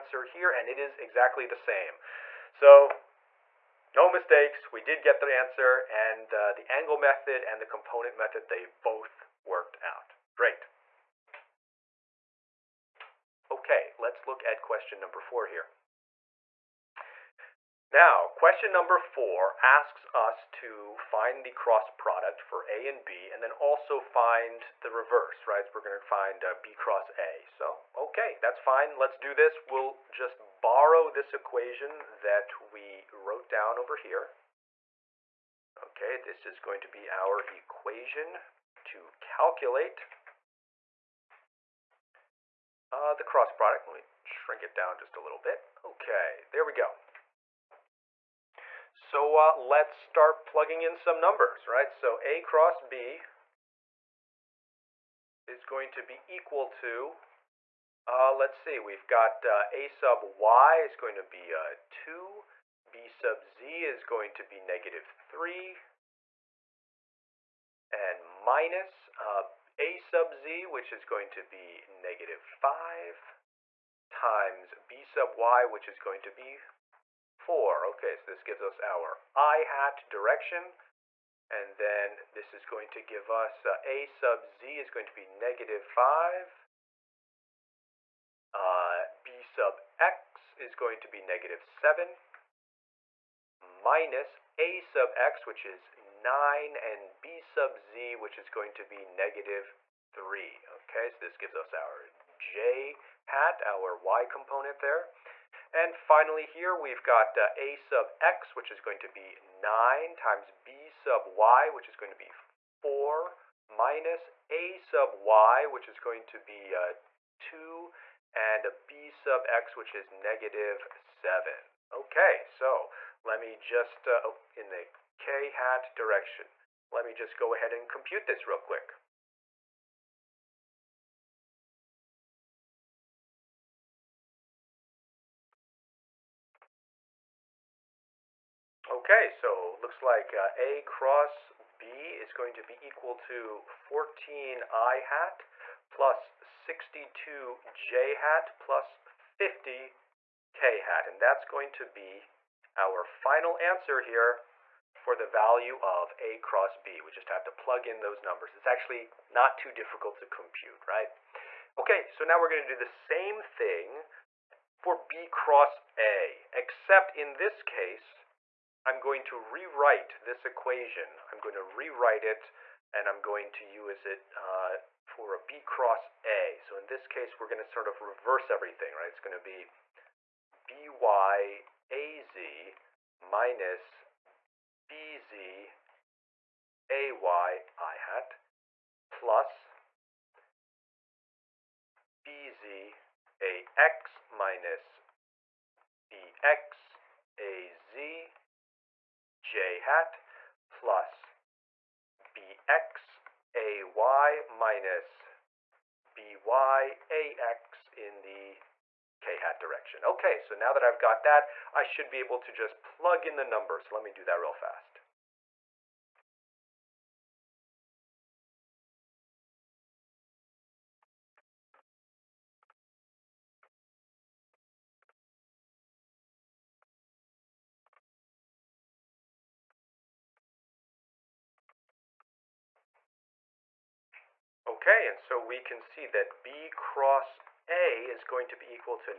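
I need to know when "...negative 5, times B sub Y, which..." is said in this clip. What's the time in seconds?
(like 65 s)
71 s.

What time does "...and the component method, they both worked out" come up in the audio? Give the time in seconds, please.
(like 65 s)
7 s.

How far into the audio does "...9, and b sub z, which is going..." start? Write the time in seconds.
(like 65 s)
95 s.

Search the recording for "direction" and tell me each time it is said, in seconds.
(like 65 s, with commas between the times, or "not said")
80 s, 125 s, 209 s.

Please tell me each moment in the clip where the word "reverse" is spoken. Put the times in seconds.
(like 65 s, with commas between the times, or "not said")
24 s, 178 s.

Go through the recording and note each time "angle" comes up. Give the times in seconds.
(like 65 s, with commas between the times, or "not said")
6 s.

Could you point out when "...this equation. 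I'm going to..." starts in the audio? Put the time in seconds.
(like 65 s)
170 s.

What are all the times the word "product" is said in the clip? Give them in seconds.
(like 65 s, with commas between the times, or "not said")
21 s, 43 s.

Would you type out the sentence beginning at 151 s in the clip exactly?
And that's going to be our final answer here for the value of A cross B.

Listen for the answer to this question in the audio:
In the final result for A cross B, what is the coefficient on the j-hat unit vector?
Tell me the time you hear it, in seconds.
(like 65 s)
146 s.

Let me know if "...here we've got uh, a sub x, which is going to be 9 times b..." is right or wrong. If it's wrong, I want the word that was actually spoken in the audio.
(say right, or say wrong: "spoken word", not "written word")
right.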